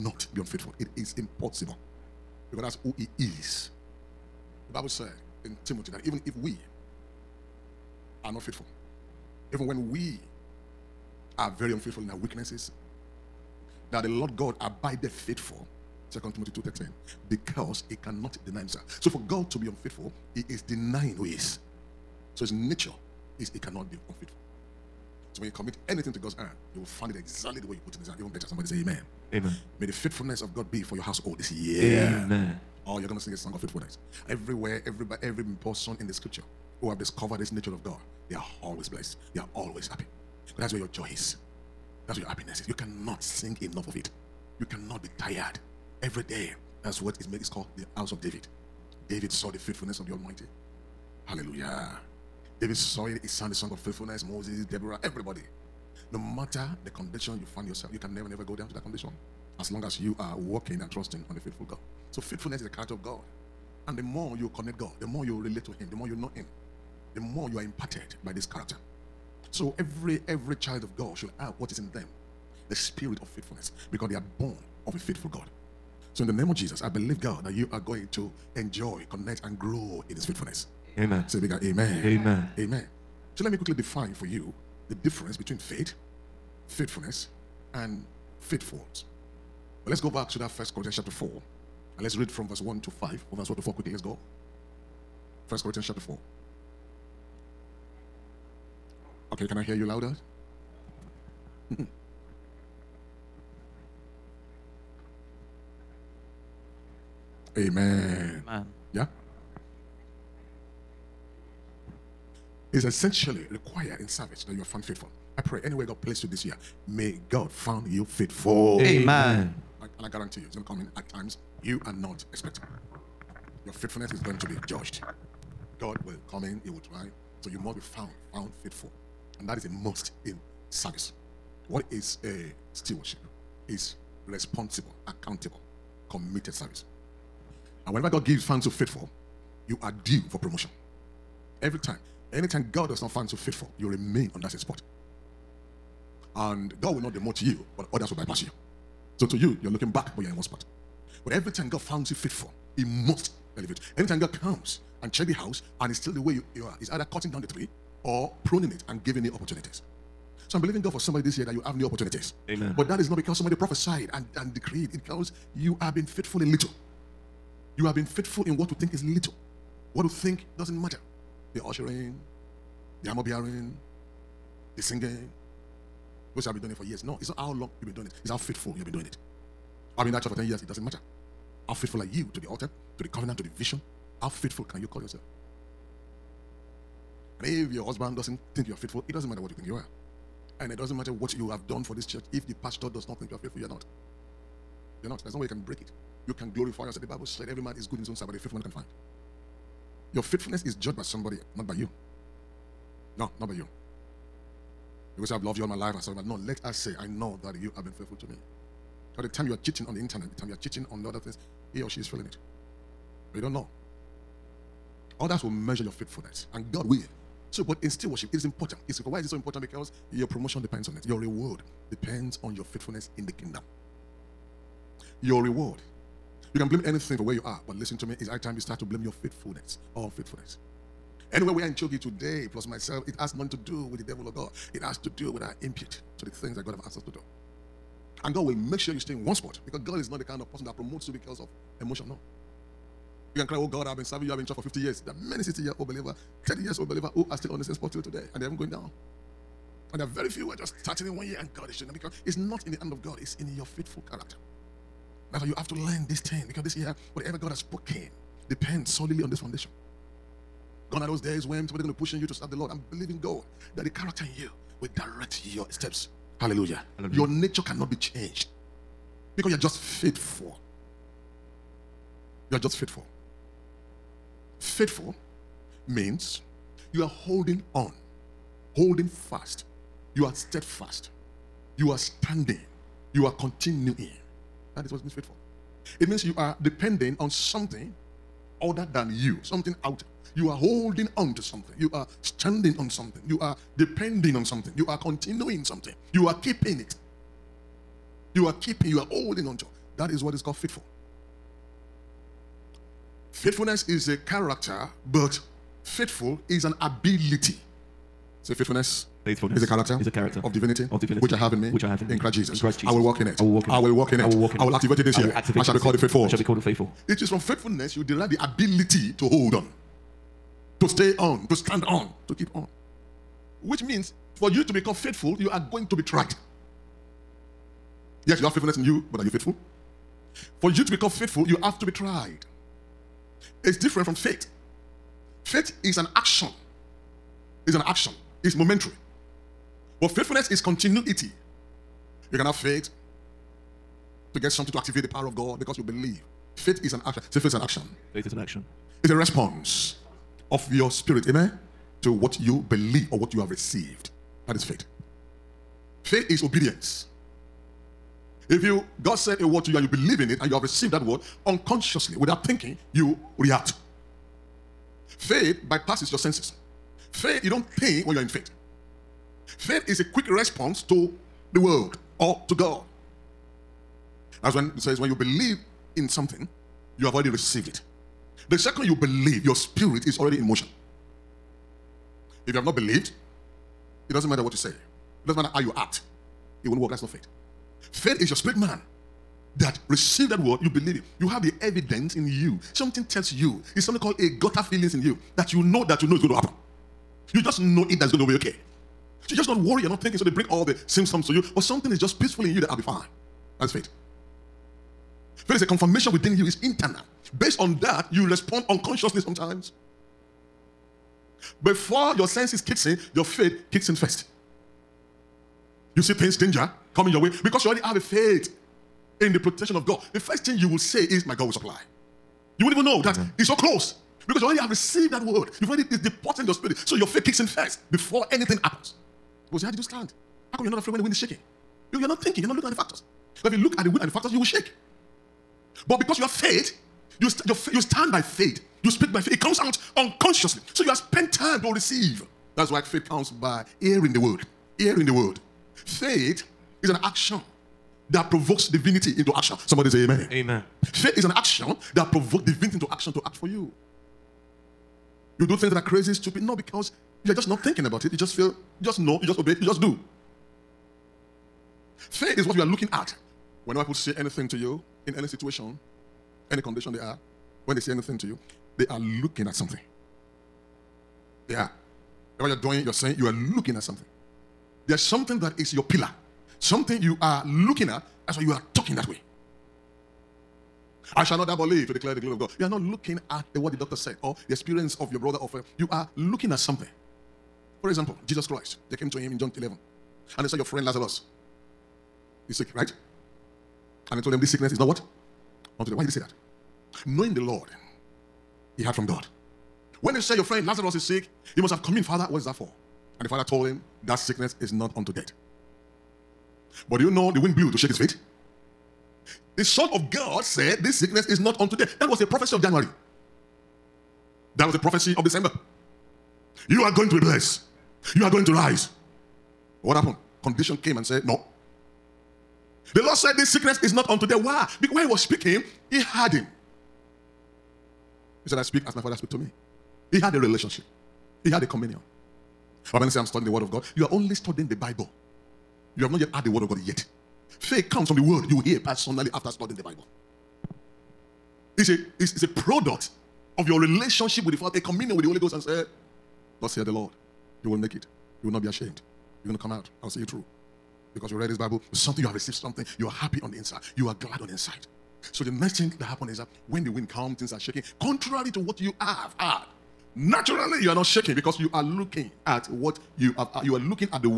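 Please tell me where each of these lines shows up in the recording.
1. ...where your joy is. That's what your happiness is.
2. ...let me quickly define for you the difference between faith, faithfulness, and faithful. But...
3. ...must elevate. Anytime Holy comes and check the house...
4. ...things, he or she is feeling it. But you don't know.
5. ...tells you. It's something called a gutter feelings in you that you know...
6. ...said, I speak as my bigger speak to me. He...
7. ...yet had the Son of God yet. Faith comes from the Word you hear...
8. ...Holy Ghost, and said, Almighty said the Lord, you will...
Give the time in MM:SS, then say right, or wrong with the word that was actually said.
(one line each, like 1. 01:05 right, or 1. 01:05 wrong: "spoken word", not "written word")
1. 00:40 right
2. 01:23 right
3. 02:32 wrong: "God", not "Holy"
4. 03:31 right
5. 06:33 right
6. 08:48 wrong: "father", not "bigger"
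7. 08:56 wrong: "Word", not "Son"
8. 09:05 wrong: "Thus", not "Almighty".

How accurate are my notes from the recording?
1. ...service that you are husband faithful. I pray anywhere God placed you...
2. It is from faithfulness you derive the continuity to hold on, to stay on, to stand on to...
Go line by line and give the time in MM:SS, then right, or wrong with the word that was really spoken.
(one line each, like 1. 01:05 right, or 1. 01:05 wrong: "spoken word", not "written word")
1. 01:54 wrong: "found", not "husband"
2. 05:17 wrong: "ability", not "continuity".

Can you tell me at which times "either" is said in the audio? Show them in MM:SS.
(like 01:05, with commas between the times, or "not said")
02:36.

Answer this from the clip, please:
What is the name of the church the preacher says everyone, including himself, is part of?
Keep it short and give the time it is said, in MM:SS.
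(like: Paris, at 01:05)
CHOGI, at 03:51.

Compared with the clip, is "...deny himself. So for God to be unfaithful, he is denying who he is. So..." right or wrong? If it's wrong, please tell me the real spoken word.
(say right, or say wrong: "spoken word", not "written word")
right.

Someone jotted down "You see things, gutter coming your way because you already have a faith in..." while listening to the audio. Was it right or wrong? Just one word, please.
wrong.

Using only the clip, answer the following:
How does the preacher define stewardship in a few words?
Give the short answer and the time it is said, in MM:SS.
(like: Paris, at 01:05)
Responsible, accountable, committed service, at 02:14.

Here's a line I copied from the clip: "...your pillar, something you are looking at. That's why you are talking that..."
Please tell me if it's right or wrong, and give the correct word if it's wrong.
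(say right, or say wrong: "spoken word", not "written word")
right.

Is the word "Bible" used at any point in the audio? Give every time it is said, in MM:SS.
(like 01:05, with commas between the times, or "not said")
00:04, 03:17, 08:54, 08:59, 09:11.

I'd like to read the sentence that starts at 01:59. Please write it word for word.
I, and I guarantee you, it's going to come in at times you are not expecting.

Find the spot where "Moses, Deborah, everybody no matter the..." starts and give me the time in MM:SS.
00:54.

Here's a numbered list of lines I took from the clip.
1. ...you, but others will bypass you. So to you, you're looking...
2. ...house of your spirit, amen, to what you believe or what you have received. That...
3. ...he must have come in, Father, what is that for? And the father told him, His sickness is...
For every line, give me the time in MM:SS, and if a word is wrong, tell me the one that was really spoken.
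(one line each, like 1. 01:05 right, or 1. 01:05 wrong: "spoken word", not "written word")
1. 02:27 right
2. 05:49 wrong: "response", not "house"
3. 08:21 wrong: "That", not "His".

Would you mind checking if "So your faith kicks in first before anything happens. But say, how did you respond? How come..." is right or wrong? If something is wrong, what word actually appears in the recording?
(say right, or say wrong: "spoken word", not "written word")
wrong: "stand", not "respond".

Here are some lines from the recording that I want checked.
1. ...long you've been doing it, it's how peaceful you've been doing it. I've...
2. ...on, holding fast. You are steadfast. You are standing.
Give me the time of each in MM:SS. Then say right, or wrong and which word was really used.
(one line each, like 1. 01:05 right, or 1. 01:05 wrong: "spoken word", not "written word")
1. 02:57 wrong: "faithful", not "peaceful"
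2. 04:37 right.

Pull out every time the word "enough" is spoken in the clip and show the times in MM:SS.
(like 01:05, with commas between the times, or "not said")
00:43.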